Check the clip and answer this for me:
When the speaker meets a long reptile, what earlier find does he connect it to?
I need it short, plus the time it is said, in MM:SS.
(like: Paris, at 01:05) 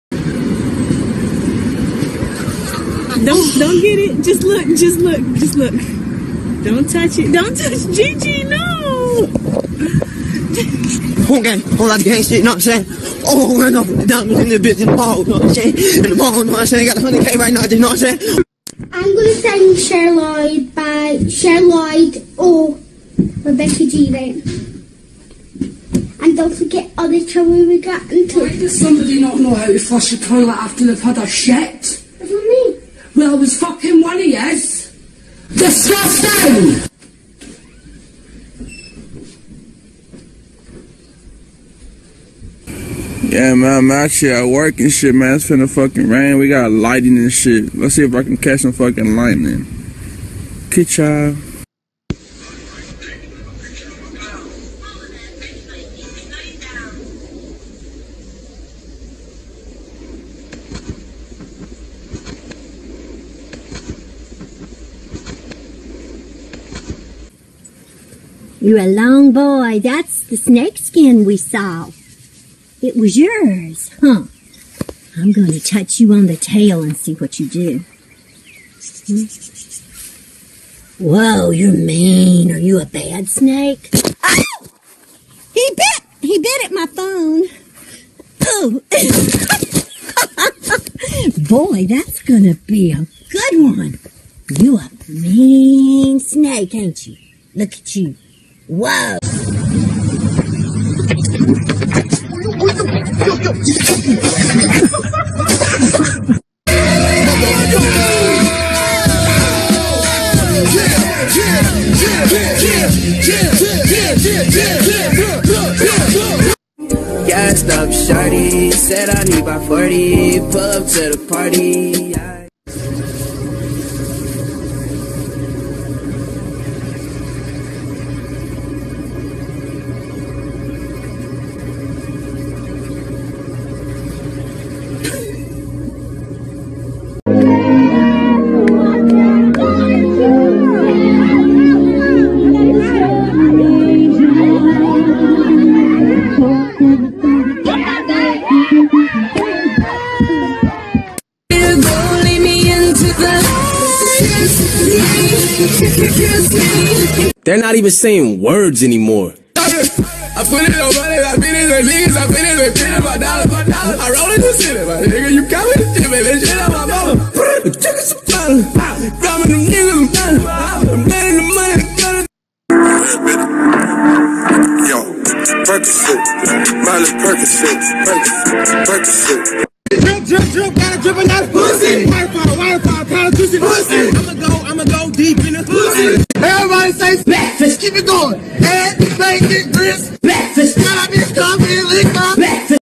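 snake skin, at 01:10.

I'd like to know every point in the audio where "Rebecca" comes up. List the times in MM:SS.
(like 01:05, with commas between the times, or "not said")
00:23.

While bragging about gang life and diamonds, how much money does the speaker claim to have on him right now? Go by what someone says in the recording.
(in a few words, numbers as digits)
100k.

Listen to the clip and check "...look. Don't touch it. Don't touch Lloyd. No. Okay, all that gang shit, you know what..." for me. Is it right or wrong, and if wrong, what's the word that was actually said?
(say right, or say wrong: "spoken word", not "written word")
wrong: "Gigi", not "Lloyd".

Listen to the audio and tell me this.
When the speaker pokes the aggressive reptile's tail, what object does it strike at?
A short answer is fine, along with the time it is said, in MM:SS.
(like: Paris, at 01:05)
phone, at 01:26.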